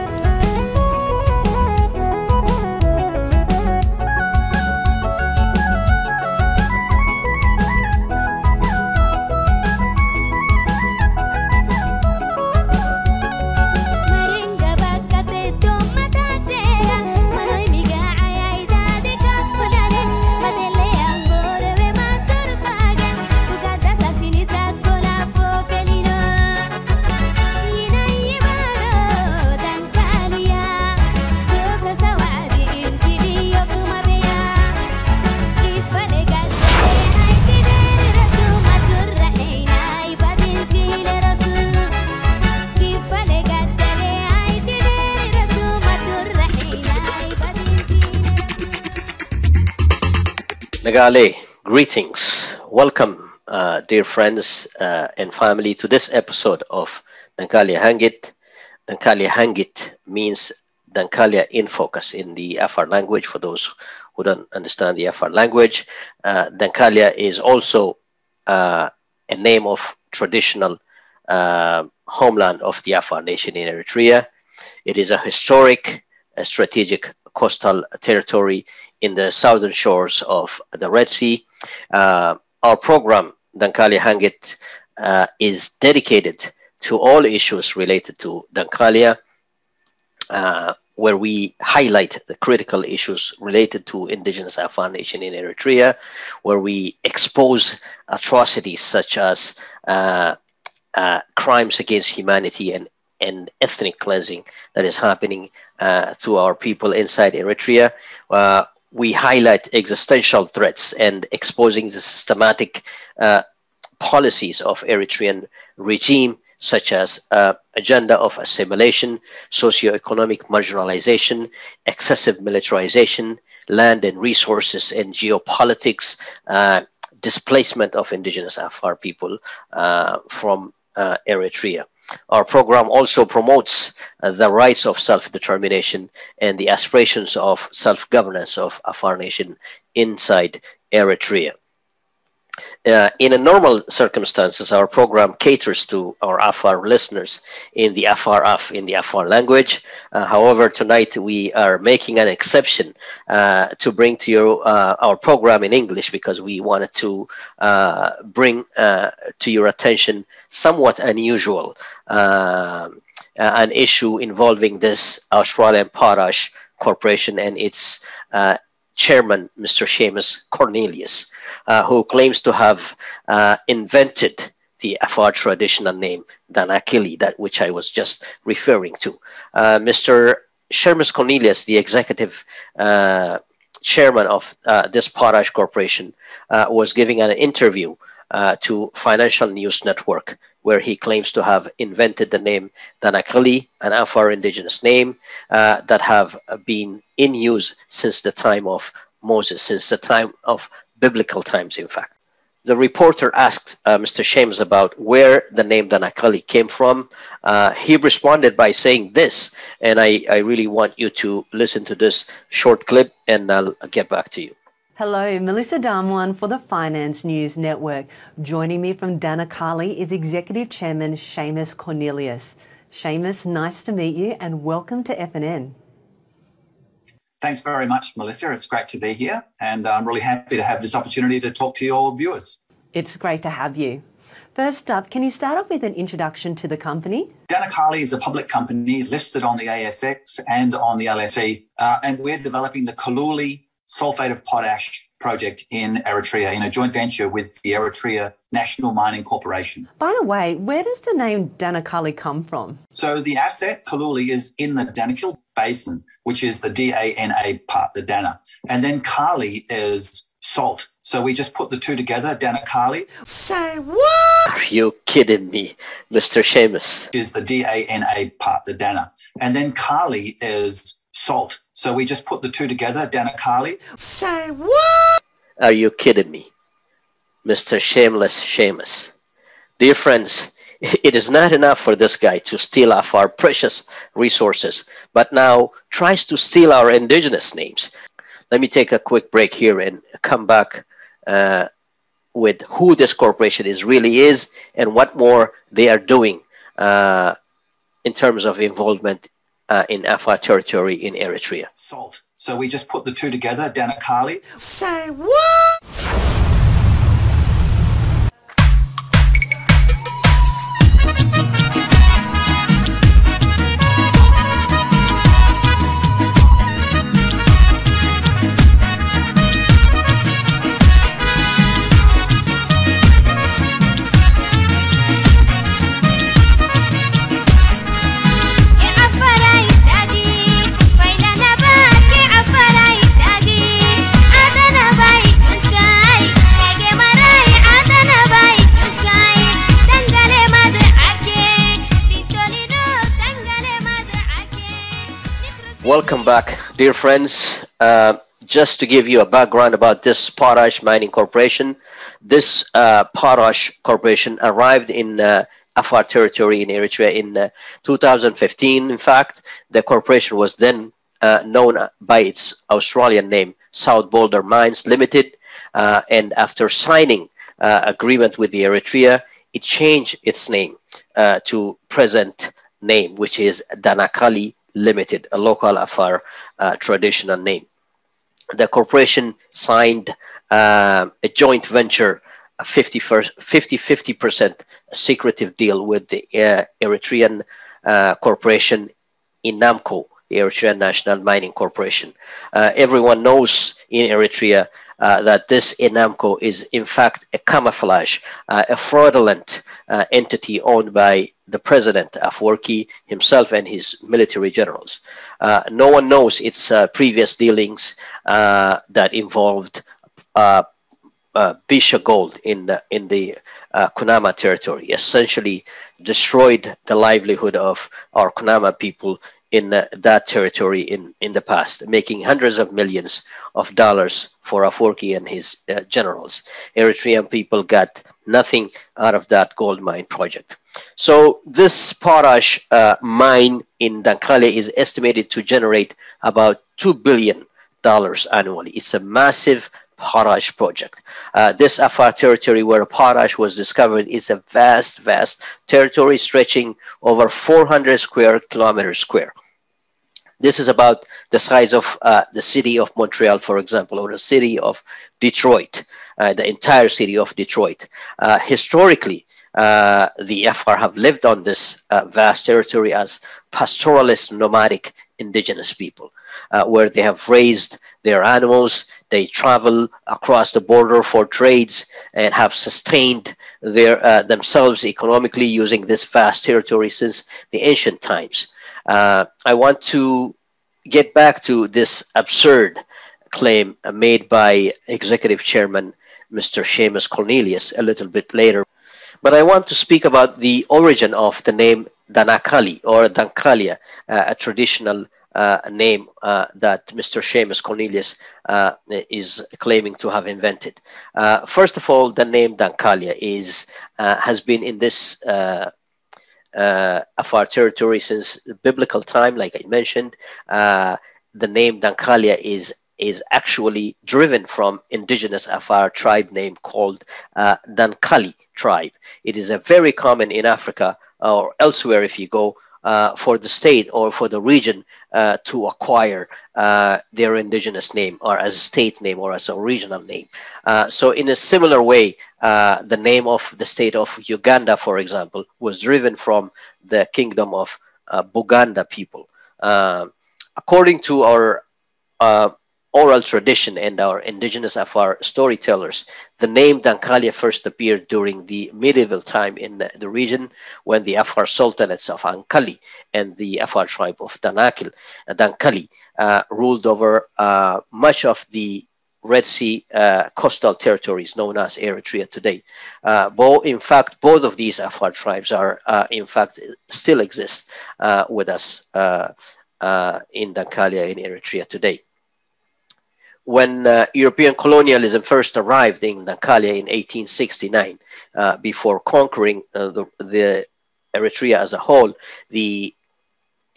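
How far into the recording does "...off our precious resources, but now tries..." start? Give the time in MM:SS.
04:42.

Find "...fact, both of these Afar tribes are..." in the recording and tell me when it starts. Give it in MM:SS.
09:23.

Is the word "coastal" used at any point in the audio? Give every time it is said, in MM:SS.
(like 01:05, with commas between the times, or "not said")
01:17, 09:20.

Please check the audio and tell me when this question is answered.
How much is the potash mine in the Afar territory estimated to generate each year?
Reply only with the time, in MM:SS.
07:16.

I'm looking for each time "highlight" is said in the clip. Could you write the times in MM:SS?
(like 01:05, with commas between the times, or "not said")
01:31, 01:49.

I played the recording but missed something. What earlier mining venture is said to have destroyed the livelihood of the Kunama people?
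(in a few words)
Bisha Gold.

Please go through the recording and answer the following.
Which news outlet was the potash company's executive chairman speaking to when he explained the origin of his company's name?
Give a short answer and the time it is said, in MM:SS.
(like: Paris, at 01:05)
Financial News Network, at 03:08.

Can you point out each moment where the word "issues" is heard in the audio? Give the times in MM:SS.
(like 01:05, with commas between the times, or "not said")
01:27, 01:32, 02:43.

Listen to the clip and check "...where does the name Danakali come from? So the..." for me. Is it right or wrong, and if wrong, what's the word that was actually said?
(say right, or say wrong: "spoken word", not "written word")
right.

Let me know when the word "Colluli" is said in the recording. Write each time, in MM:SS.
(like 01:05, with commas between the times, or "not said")
04:02, 04:13.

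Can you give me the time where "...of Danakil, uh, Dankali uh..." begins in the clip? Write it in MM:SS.
09:14.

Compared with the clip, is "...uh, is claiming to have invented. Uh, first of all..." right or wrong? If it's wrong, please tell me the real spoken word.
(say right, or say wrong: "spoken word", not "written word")
right.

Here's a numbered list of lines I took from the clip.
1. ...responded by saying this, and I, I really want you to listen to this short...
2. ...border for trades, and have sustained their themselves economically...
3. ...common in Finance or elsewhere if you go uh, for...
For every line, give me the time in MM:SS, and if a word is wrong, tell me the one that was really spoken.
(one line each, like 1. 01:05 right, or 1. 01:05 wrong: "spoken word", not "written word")
1. 03:27 right
2. 07:50 right
3. 08:39 wrong: "Africa", not "Finance".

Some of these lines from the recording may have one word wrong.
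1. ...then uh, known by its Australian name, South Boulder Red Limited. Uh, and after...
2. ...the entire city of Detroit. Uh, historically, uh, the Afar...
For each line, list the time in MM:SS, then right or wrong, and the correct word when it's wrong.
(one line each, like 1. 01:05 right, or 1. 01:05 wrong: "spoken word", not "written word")
1. 06:00 wrong: "Mines", not "Red"
2. 07:36 right.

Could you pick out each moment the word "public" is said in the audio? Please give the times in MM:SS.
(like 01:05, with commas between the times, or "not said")
03:58.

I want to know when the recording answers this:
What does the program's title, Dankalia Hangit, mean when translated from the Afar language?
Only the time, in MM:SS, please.
01:00.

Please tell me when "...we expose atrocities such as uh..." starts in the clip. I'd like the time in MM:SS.
01:36.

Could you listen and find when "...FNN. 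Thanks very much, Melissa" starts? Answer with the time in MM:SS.
03:45.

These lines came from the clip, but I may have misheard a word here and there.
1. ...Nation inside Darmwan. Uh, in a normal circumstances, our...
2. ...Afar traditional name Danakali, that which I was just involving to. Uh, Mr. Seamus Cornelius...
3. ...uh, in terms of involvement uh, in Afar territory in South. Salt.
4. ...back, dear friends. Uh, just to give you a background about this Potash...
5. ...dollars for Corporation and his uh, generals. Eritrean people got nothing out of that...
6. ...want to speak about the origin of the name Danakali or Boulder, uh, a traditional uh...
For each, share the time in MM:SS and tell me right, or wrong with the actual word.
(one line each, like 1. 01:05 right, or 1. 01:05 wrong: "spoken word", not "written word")
1. 02:19 wrong: "Eritrea", not "Darmwan"
2. 02:55 wrong: "referring", not "involving"
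3. 04:56 wrong: "Eritrea", not "South"
4. 05:46 right
5. 07:03 wrong: "Afwerki", not "Corporation"
6. 08:09 wrong: "Dankalia", not "Boulder".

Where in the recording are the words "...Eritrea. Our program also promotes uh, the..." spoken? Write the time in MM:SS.
02:10.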